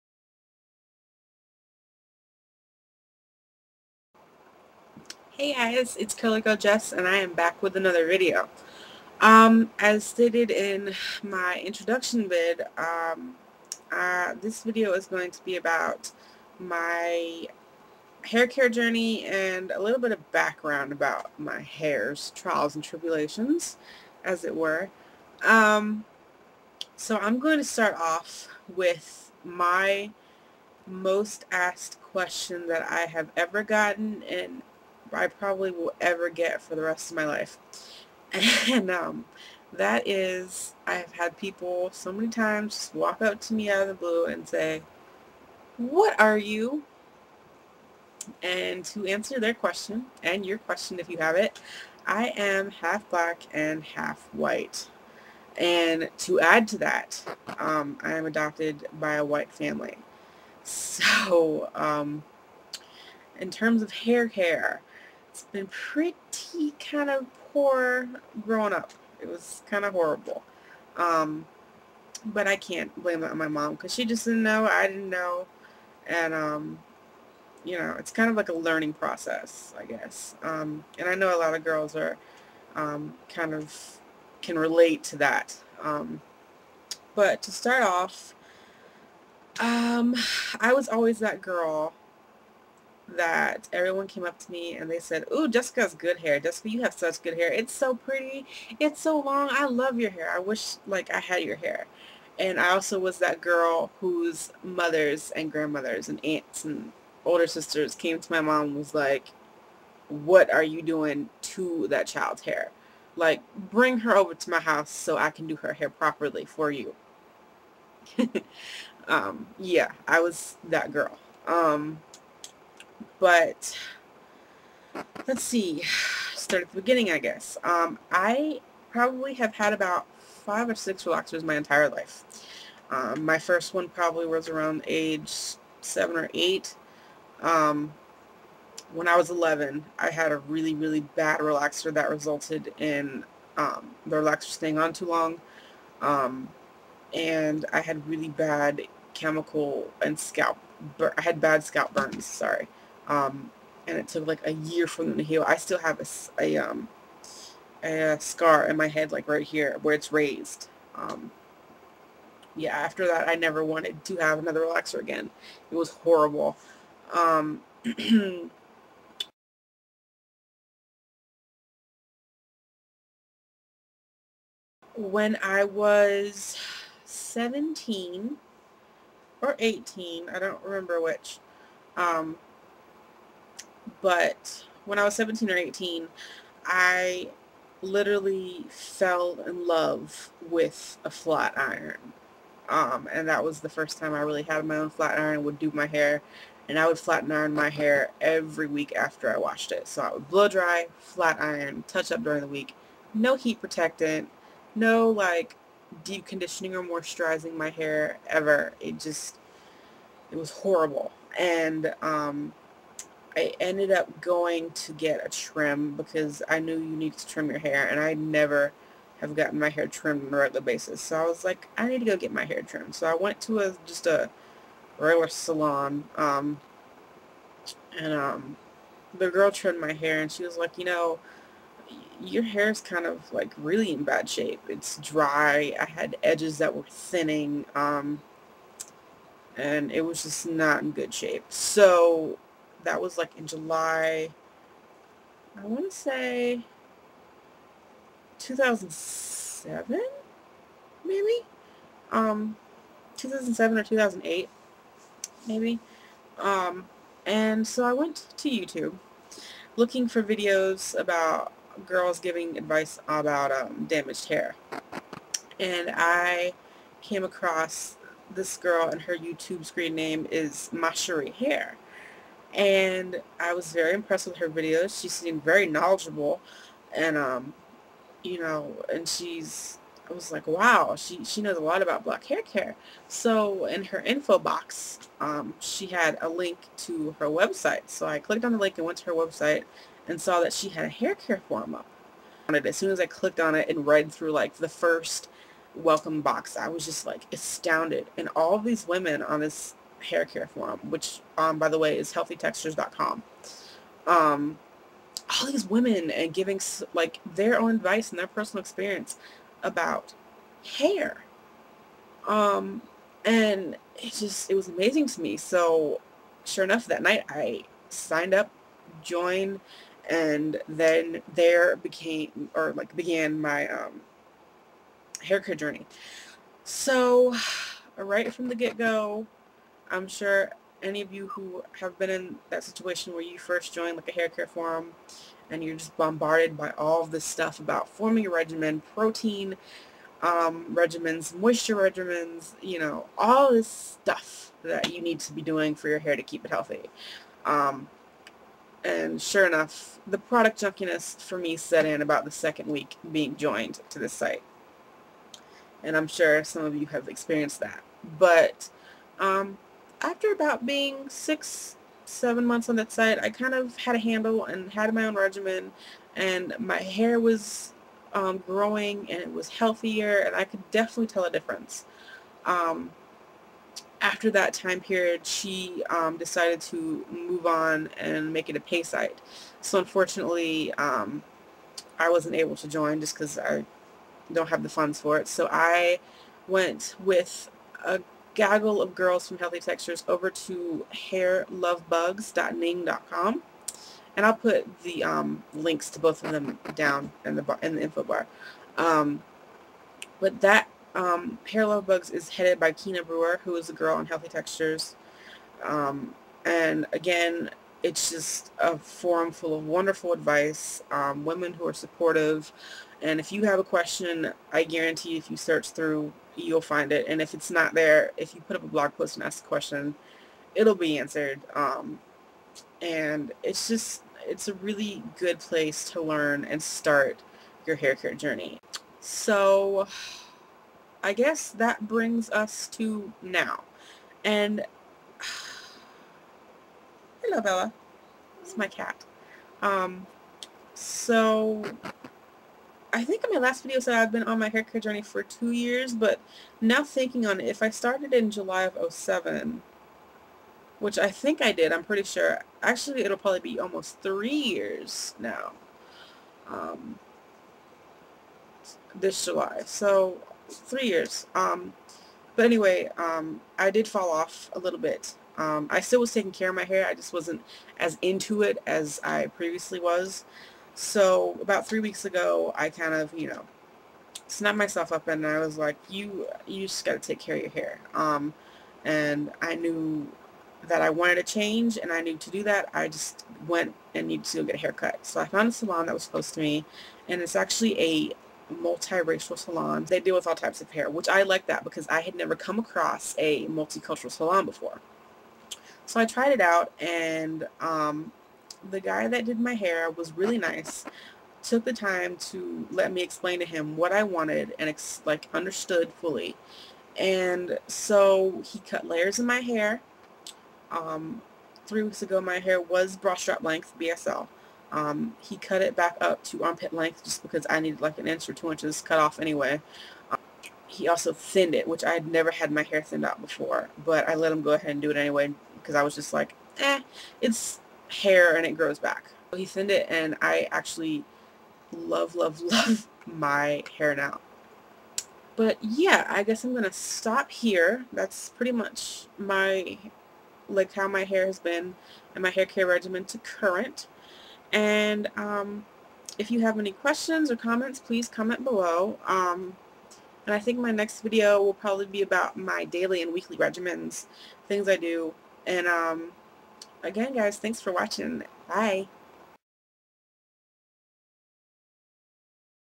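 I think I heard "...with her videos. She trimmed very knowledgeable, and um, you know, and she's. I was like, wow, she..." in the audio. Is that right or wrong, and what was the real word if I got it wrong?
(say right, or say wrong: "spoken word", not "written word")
wrong: "seemed", not "trimmed".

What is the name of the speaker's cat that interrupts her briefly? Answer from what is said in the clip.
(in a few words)
Bella.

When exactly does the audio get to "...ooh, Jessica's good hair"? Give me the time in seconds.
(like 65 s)
95 s.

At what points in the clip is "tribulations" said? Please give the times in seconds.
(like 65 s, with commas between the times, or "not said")
22 s.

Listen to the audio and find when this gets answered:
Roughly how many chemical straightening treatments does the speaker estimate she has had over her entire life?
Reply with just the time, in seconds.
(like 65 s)
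130 s.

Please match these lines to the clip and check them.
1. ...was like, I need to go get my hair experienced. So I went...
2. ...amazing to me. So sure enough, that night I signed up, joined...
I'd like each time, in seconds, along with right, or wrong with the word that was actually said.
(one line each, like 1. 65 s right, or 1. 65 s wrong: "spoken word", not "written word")
1. 221 s wrong: "trimmed", not "experienced"
2. 314 s right.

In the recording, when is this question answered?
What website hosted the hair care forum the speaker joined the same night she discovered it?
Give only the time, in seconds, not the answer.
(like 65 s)
302 s.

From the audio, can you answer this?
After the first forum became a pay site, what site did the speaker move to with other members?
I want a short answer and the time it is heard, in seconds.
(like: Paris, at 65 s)
hairluvbugs.ning.com, at 390 s.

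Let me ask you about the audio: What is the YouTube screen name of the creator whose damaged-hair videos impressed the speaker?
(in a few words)
Macherie Hair.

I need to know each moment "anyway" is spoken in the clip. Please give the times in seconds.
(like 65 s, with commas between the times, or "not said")
462 s, 519 s, 524 s.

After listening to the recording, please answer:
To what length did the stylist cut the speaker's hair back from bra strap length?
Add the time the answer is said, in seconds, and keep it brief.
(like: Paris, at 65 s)
armpit length, at 516 s.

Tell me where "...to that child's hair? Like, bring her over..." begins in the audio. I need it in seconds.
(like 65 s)
111 s.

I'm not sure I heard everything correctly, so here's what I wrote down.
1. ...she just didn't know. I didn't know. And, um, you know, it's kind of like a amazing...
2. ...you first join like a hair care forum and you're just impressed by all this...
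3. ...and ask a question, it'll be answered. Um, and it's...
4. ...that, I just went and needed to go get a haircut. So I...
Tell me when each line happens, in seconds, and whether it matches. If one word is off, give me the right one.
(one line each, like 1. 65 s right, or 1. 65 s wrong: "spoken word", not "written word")
1. 73 s wrong: "learning", not "amazing"
2. 333 s wrong: "bombarded", not "impressed"
3. 419 s right
4. 482 s right.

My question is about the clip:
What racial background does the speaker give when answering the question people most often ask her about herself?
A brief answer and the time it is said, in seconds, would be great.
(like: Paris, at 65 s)
half black and half white, at 52 s.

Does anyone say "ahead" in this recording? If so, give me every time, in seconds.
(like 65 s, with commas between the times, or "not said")
524 s.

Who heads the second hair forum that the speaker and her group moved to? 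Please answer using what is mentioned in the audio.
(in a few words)
Kina Brewer.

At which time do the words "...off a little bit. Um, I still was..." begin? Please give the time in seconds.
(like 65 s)
464 s.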